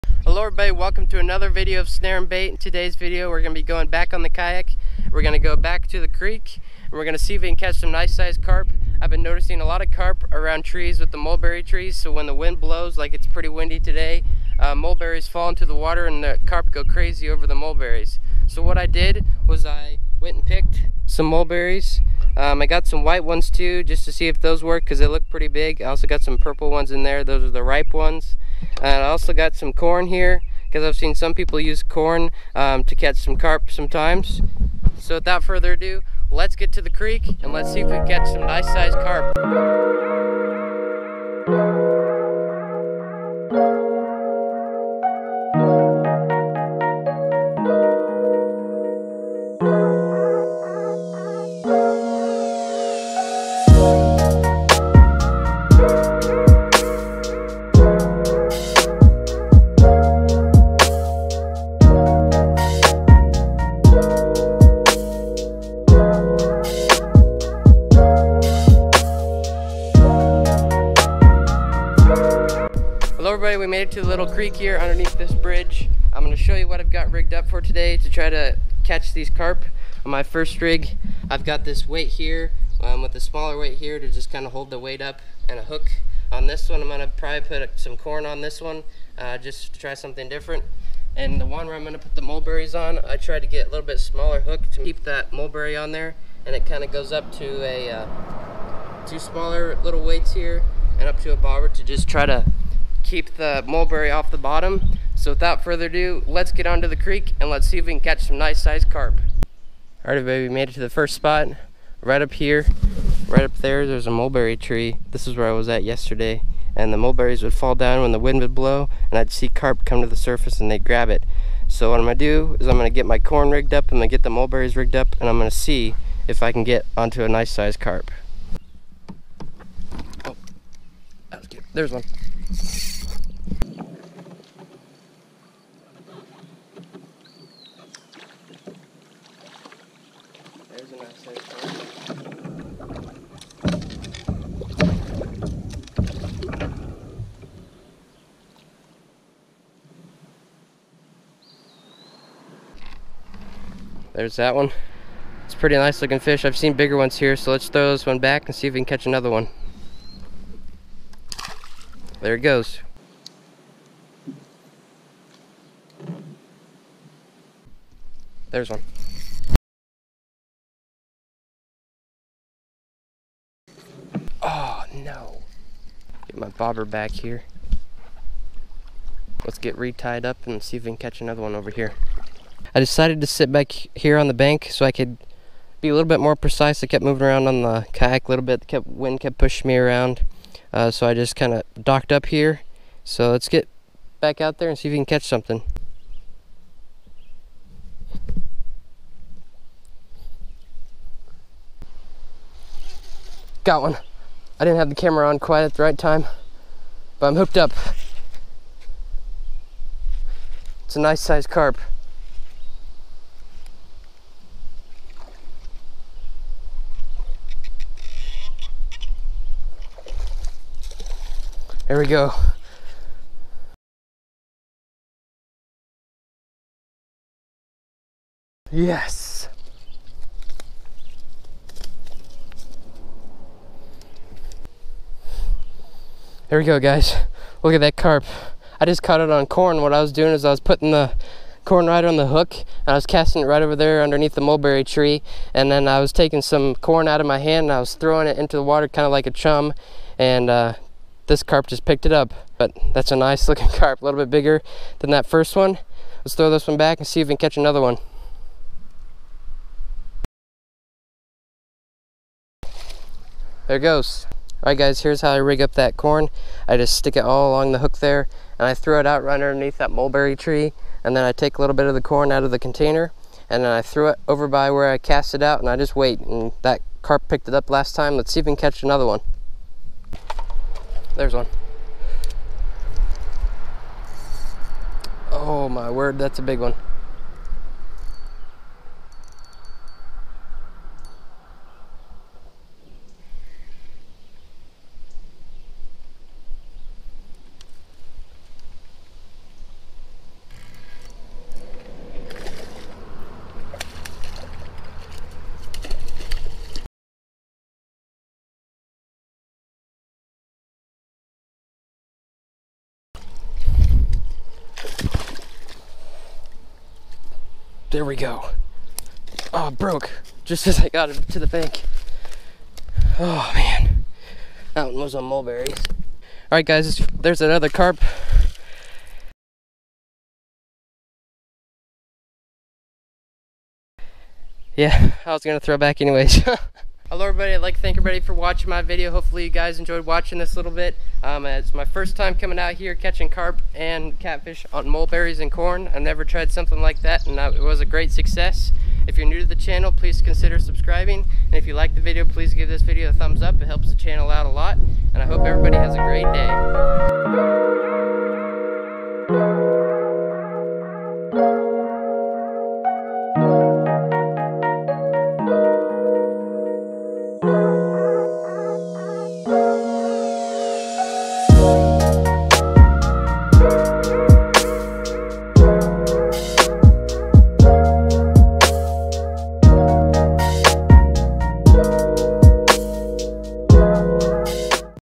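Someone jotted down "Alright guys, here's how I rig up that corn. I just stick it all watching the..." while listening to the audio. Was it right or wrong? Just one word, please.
wrong.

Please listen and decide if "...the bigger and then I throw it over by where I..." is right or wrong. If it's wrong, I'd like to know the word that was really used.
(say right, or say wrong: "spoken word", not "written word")
wrong: "container", not "bigger".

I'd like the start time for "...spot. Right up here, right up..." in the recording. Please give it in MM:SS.
01:51.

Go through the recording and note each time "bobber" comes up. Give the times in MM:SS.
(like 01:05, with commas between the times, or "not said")
01:41, 02:56.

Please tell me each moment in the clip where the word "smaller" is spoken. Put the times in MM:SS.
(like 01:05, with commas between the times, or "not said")
01:23, 01:33, 01:39.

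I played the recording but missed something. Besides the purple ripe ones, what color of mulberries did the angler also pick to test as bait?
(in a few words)
White.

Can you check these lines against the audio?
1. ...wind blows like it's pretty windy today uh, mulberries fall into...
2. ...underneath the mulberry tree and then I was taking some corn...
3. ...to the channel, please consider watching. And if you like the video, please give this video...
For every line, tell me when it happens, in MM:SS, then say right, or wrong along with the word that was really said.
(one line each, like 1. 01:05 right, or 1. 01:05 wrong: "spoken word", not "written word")
1. 00:12 right
2. 04:04 right
3. 05:49 wrong: "subscribing", not "watching".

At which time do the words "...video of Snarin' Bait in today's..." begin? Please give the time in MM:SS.
00:01.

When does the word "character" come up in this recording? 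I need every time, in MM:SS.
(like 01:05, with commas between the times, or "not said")
not said.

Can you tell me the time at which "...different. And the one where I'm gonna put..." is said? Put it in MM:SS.
01:30.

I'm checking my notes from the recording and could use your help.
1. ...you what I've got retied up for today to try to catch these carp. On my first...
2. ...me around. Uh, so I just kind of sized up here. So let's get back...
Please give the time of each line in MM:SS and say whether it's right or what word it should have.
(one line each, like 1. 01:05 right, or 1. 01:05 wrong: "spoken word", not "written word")
1. 01:16 wrong: "rigged", not "retied"
2. 03:09 wrong: "docked", not "sized".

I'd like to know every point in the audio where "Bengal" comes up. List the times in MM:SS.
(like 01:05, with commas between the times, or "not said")
not said.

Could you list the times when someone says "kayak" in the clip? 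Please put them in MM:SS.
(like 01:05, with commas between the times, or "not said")
00:04, 03:07.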